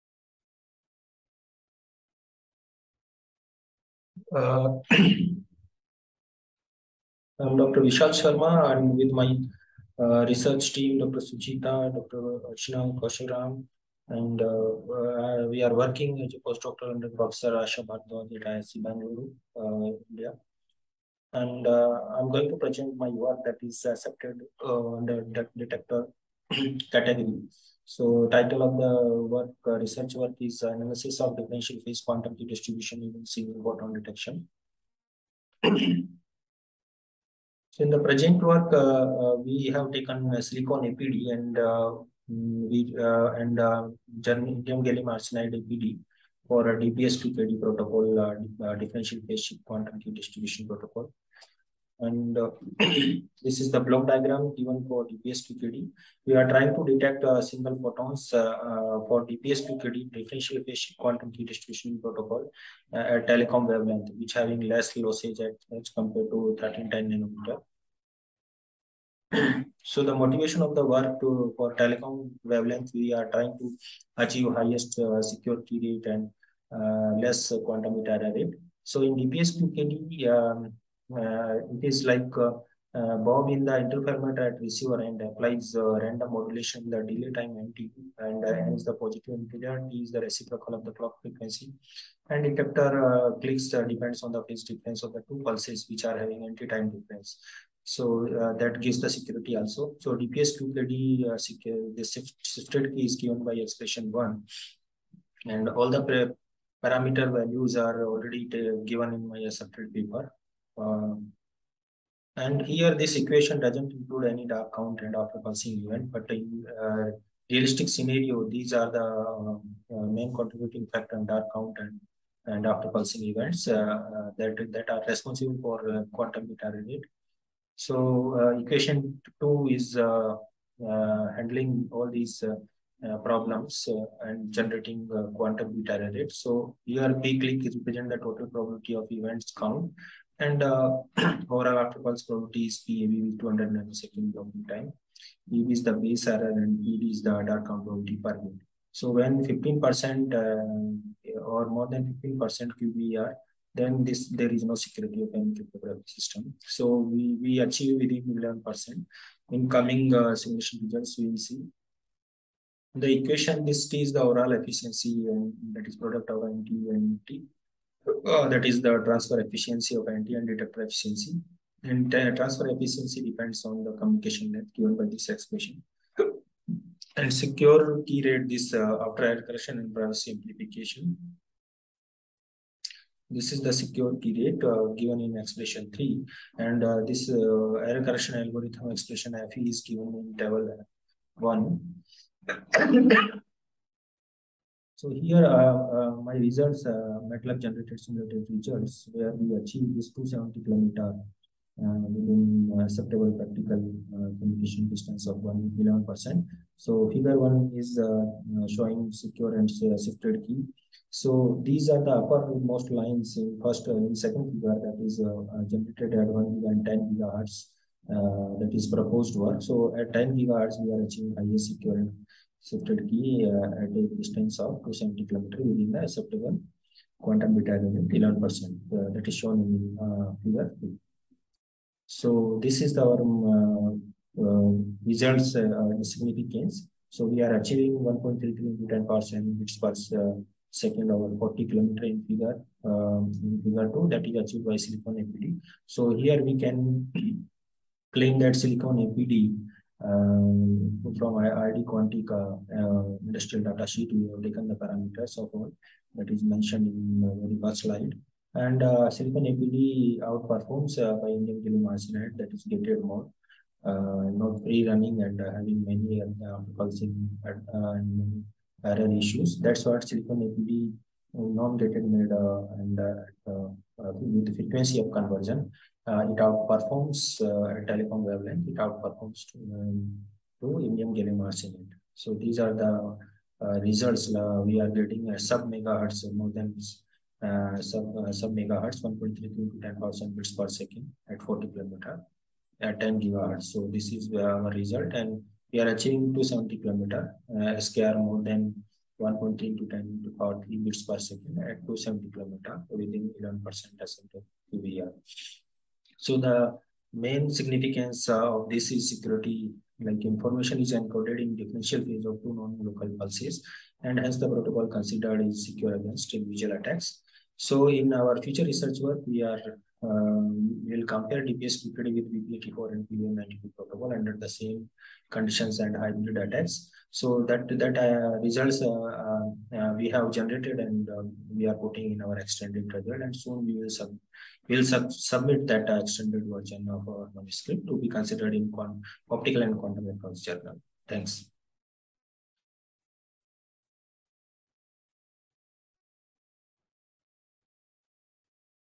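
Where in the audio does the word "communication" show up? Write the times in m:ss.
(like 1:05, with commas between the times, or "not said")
2:53, 3:24.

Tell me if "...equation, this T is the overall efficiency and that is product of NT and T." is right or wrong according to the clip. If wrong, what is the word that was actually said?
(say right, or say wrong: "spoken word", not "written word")
right.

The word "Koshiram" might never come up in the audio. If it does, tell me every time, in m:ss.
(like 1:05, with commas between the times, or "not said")
0:12.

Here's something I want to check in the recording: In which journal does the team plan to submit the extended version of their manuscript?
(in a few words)
Optical and Quantum Electronics.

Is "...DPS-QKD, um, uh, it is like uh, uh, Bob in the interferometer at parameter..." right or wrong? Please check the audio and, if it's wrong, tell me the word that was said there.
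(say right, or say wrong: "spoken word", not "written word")
wrong: "receiver", not "parameter".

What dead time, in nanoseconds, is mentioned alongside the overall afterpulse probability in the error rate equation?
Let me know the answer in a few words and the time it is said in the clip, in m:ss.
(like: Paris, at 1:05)
200 nanoseconds, at 2:23.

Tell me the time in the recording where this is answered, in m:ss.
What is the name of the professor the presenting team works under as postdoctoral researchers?
0:17.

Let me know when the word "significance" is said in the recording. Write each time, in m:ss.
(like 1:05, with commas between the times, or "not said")
3:56, 5:07.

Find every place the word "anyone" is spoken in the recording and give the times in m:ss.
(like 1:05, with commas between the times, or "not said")
not said.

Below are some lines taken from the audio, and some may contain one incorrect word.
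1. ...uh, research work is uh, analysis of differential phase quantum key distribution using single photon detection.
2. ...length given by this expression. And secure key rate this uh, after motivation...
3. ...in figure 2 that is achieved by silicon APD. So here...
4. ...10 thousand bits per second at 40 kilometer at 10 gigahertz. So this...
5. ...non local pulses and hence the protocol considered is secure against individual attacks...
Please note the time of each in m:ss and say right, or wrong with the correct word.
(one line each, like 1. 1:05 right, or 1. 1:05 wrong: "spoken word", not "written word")
1. 0:29 right
2. 2:54 wrong: "correction", not "motivation"
3. 4:03 right
4. 4:49 right
5. 5:12 wrong: "visual", not "individual".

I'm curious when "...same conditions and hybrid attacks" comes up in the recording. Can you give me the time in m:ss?
5:24.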